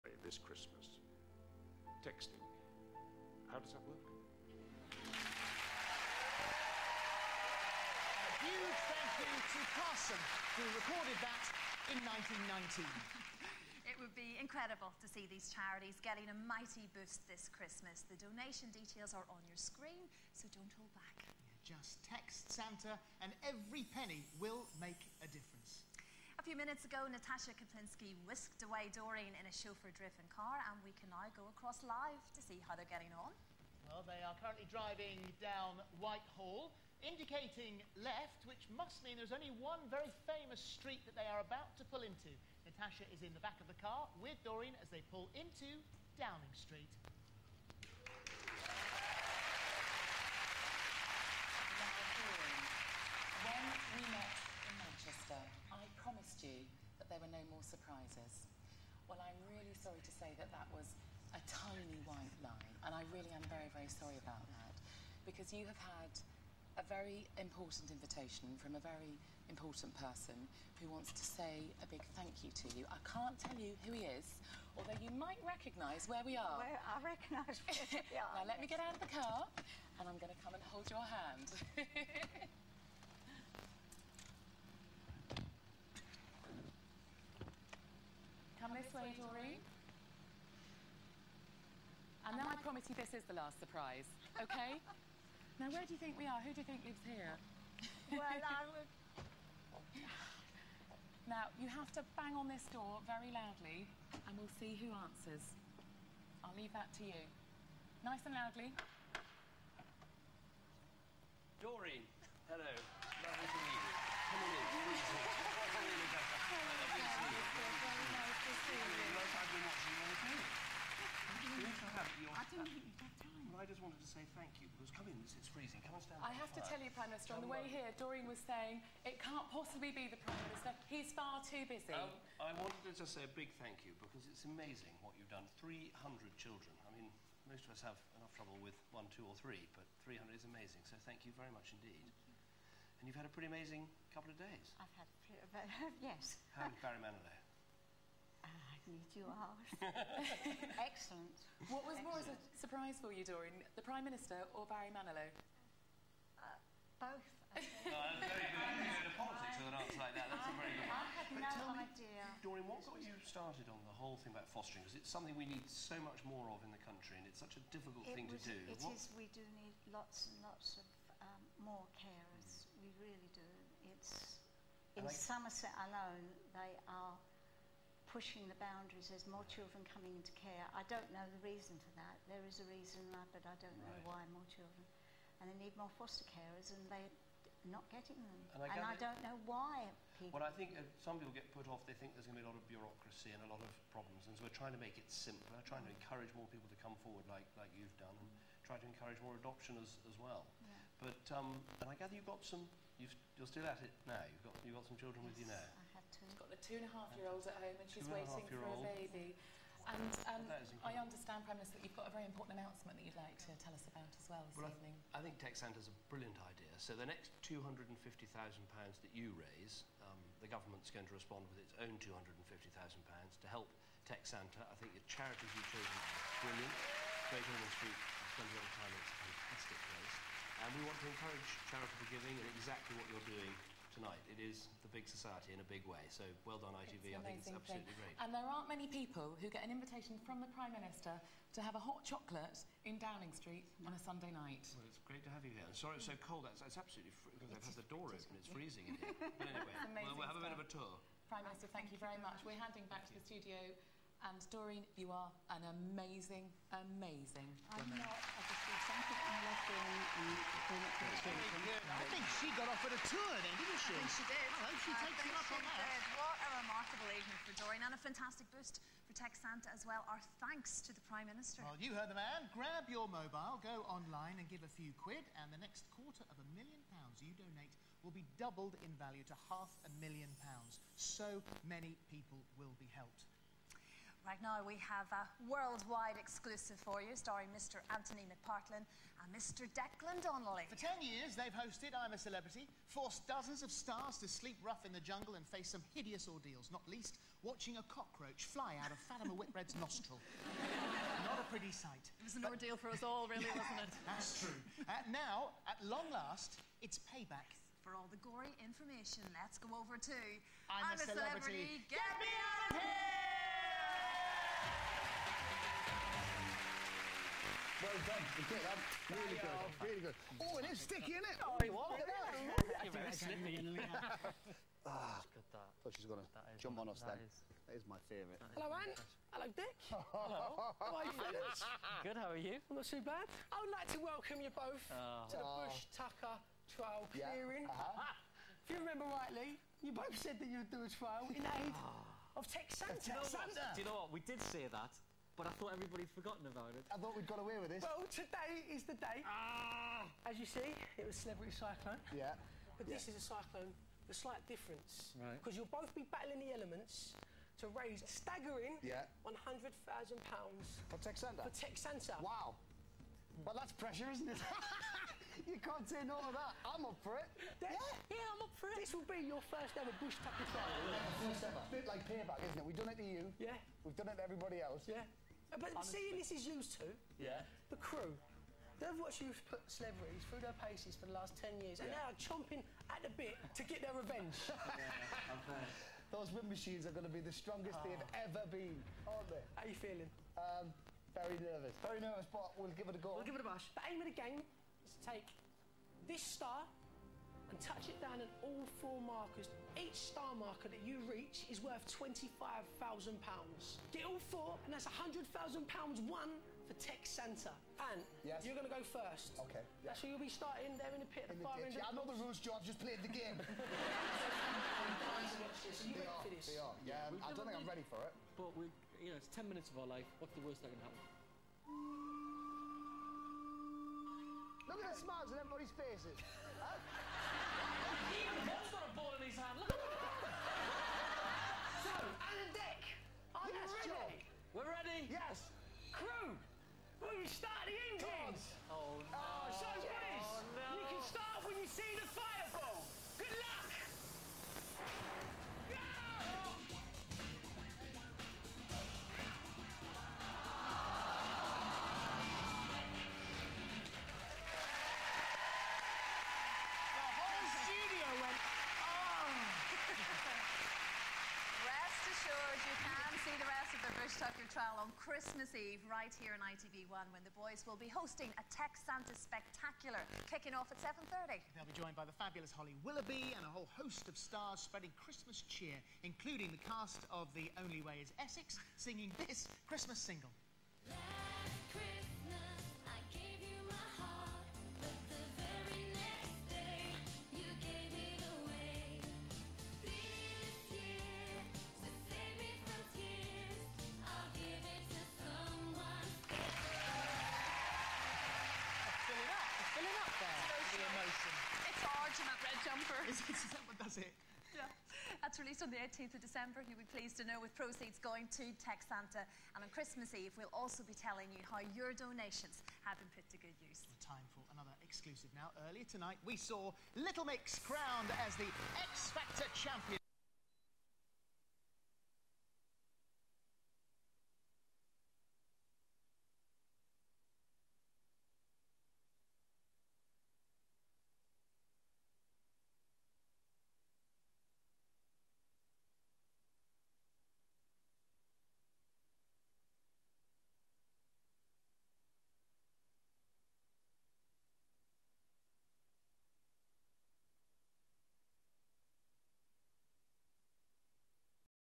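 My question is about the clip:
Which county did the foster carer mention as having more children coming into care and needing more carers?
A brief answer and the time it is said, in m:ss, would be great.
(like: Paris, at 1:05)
Somerset, at 2:55.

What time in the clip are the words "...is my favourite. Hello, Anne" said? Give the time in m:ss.
5:27.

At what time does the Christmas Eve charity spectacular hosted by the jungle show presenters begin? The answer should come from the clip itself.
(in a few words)
7.30.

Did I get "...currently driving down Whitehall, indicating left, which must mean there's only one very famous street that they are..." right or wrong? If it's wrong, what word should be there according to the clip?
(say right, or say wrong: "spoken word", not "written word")
right.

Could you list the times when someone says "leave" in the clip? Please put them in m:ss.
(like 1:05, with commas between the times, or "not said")
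1:46.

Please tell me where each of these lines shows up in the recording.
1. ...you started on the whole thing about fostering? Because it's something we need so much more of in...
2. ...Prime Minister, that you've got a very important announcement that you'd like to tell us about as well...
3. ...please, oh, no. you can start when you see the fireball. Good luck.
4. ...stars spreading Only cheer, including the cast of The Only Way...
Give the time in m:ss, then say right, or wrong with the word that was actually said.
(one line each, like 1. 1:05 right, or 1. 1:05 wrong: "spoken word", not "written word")
1. 2:43 right
2. 3:31 right
3. 7:19 right
4. 7:54 wrong: "Christmas", not "Only".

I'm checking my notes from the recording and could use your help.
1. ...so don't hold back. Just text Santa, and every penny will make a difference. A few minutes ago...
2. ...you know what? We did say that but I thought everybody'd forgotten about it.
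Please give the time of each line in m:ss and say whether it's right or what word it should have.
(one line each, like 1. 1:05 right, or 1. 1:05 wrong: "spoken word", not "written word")
1. 0:20 right
2. 5:43 right.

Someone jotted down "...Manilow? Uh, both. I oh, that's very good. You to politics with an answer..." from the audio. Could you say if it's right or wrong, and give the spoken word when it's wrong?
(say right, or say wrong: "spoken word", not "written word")
right.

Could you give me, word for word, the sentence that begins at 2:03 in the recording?
Well, I just wanted to say thank you, because come in, it's freezing.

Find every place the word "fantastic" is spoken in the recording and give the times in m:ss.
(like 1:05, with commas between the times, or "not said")
3:49, 4:28.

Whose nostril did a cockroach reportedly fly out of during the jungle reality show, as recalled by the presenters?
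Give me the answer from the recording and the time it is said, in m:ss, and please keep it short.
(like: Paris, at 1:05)
Fatima Whitbread, at 4:59.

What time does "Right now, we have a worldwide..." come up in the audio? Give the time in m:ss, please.
4:44.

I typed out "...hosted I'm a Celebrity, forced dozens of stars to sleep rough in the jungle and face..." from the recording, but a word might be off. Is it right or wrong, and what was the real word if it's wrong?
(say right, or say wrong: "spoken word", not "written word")
right.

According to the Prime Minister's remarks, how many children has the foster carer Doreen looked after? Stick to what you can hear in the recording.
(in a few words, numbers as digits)
300.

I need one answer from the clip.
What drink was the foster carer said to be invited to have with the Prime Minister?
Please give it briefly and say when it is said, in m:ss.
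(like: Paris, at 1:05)
Hot chocolate, at 4:01.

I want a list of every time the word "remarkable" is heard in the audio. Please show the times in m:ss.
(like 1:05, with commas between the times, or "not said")
4:26.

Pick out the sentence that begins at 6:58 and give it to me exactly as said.
But we, you know, it's 10 minutes of our life.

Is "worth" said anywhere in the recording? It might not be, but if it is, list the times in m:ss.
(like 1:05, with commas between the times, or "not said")
6:41.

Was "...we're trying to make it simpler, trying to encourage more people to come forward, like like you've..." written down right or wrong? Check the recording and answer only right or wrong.
right.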